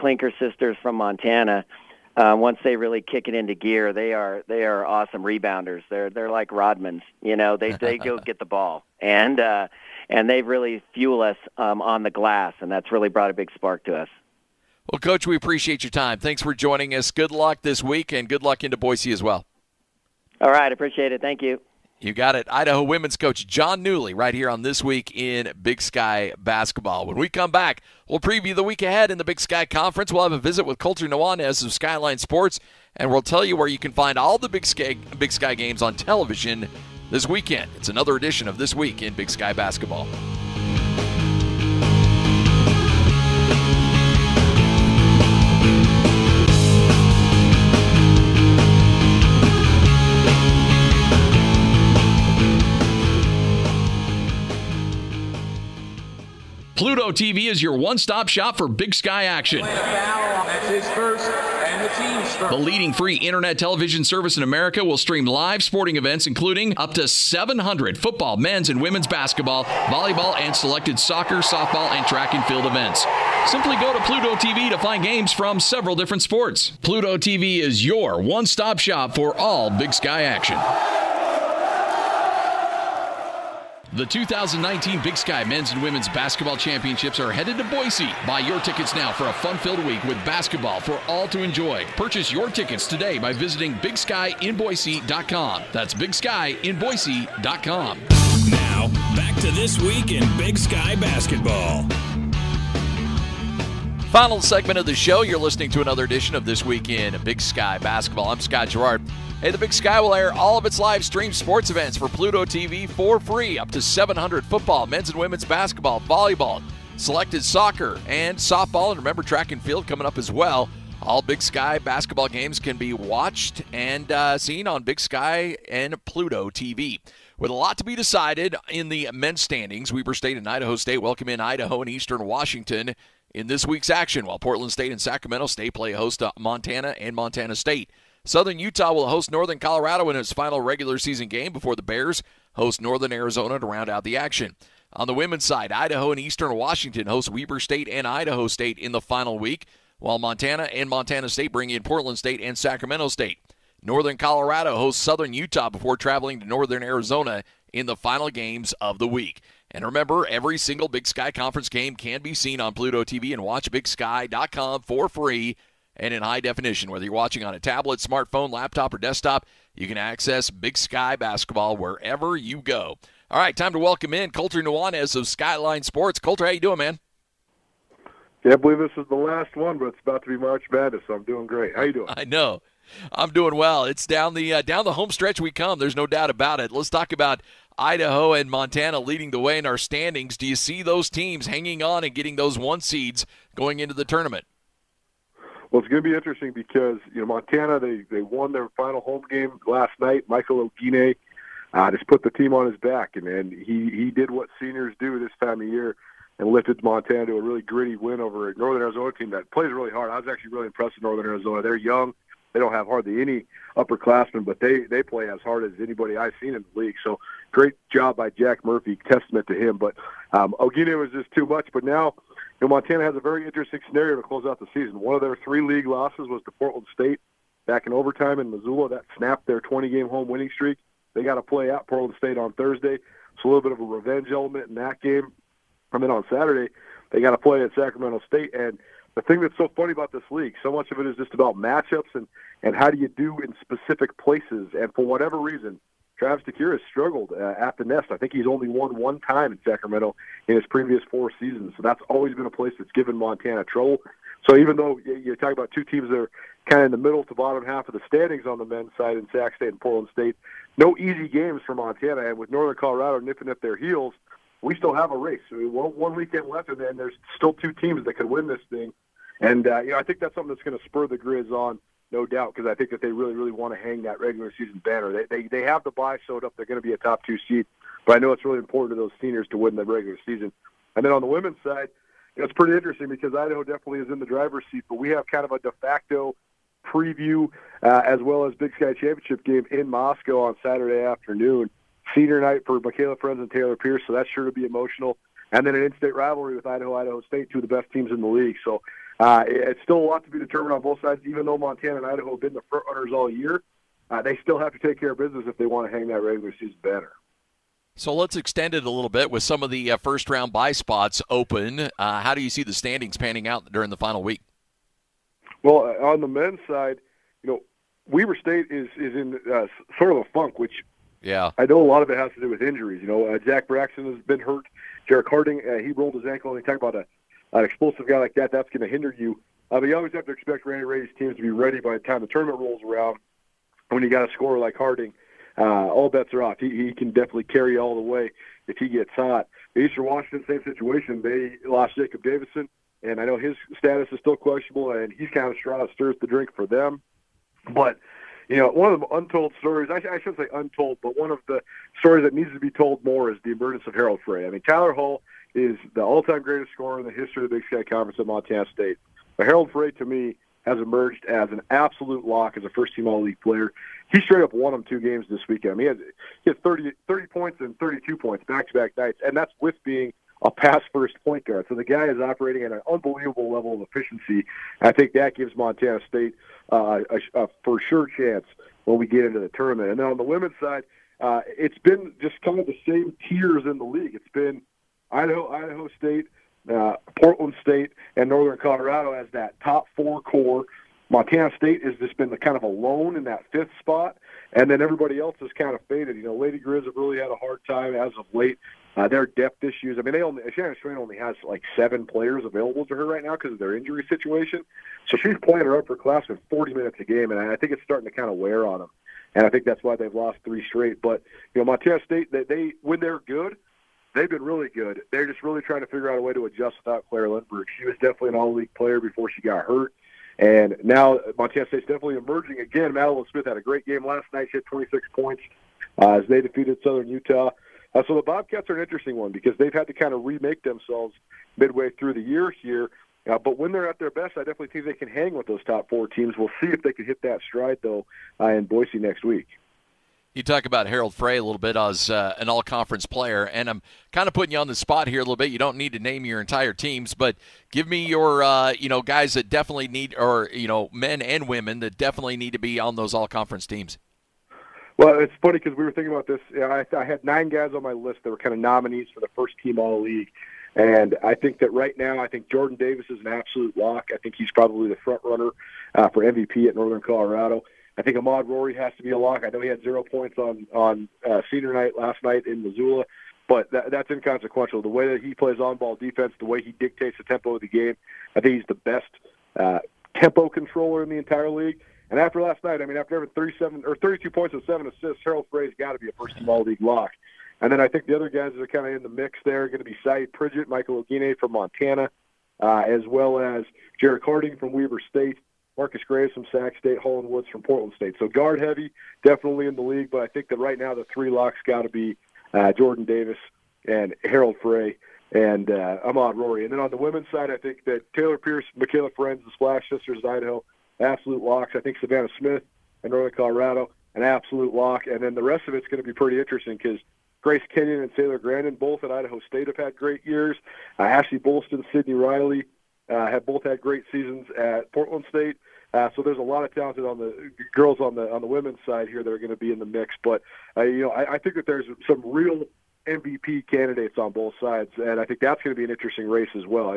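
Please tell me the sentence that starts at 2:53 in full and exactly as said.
All right, time to welcome in Colter Nuanez of Skyline Sports.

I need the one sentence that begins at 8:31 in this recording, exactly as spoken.
I think Savannah Smith in Northern Colorado, an absolute lock.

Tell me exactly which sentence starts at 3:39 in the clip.
But um, Oguine was just too much.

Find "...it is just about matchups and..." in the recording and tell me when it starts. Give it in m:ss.
4:01.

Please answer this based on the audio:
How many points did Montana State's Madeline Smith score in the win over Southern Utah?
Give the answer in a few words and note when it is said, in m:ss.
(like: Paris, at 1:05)
26, at 7:04.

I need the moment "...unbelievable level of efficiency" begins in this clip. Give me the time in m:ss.
6:12.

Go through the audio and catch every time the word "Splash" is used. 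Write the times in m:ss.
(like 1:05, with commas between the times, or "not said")
8:29.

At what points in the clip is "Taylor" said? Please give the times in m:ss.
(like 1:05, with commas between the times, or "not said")
4:53, 8:28, 8:38.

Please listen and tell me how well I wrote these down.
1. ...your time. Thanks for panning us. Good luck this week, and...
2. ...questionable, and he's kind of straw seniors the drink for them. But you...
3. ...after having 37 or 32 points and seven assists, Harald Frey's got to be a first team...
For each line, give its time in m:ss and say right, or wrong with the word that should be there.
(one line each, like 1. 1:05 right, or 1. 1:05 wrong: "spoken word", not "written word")
1. 0:15 wrong: "joining", not "panning"
2. 5:44 wrong: "stirs", not "seniors"
3. 8:02 right.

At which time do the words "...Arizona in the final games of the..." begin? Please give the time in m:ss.
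2:36.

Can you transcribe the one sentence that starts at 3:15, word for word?
Well, it's going to be interesting because you know Montana they they won their final home game last night.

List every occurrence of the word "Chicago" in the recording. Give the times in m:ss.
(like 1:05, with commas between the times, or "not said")
not said.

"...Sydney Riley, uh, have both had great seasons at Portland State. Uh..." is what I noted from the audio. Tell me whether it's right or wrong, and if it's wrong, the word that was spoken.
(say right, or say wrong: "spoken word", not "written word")
right.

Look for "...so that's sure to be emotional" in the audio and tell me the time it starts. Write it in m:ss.
4:54.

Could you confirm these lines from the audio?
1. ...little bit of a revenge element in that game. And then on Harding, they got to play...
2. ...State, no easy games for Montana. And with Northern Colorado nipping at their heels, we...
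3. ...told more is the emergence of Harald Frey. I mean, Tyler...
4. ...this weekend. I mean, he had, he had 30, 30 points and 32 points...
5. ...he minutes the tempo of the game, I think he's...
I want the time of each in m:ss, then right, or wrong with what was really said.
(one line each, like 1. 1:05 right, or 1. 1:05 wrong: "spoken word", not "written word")
1. 3:53 wrong: "Saturday", not "Harding"
2. 4:20 right
3. 5:52 right
4. 6:05 right
5. 7:56 wrong: "dictates", not "minutes".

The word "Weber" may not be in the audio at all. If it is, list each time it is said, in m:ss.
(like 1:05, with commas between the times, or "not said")
2:09, 2:27, 5:18, 8:14.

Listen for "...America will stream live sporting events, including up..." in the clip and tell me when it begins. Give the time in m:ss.
1:04.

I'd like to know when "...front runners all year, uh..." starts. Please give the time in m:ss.
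5:02.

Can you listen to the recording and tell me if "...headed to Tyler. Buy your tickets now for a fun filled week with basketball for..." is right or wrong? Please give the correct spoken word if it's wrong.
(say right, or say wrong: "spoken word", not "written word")
wrong: "Boise", not "Tyler".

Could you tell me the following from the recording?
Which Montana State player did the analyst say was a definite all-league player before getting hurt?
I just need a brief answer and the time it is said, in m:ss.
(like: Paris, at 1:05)
Claire Lindbergh, at 6:57.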